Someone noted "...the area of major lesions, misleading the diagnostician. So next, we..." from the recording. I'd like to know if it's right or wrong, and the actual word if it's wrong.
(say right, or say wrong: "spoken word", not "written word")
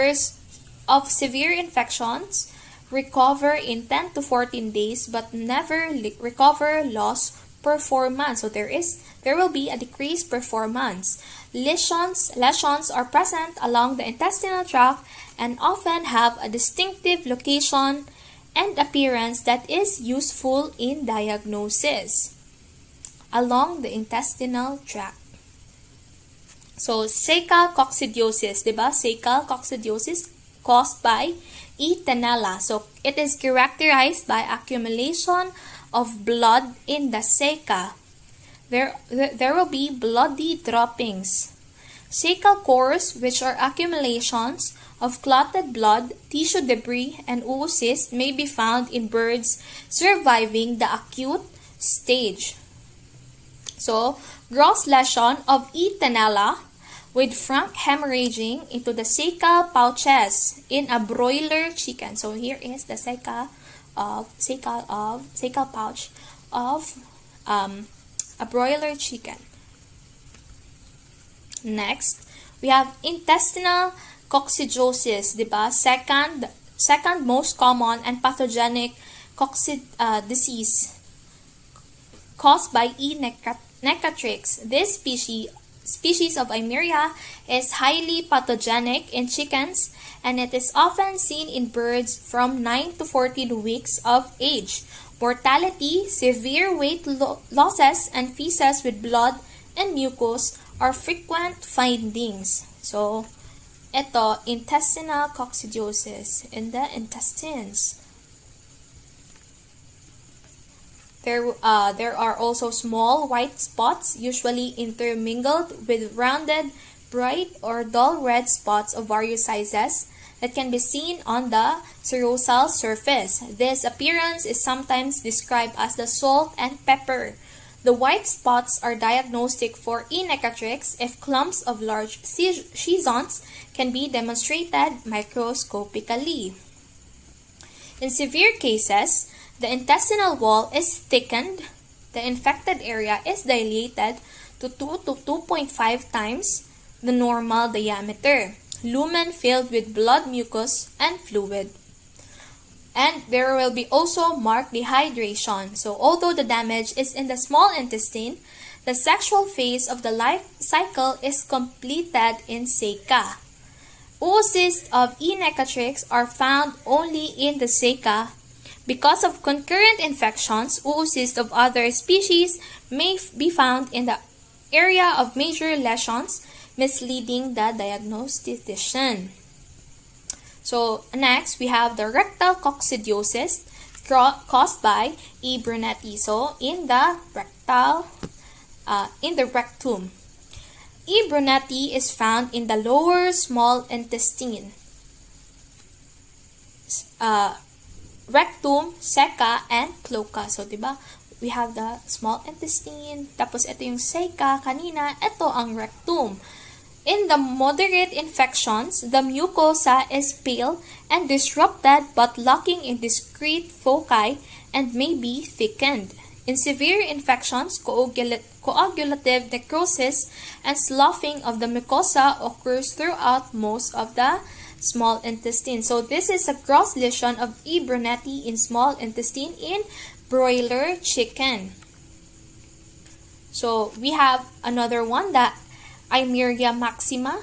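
right.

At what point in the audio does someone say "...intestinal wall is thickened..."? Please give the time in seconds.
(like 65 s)
139 s.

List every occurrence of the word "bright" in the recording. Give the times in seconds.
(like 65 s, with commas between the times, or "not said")
117 s.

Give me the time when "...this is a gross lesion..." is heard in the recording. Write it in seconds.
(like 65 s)
225 s.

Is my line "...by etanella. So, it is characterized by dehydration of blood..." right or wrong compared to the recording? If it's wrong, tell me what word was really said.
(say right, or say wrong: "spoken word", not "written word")
wrong: "accumulation", not "dehydration".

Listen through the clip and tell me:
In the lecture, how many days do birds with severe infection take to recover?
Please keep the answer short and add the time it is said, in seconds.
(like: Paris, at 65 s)
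10 to 14 days, at 3 s.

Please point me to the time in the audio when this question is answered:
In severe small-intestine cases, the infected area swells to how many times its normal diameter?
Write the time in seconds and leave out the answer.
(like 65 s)
144 s.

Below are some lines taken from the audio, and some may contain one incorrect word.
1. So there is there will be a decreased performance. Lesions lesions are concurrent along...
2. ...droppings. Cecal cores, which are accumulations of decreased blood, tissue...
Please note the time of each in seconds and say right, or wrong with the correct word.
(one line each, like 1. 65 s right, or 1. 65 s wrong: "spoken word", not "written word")
1. 8 s wrong: "present", not "concurrent"
2. 40 s wrong: "clotted", not "decreased".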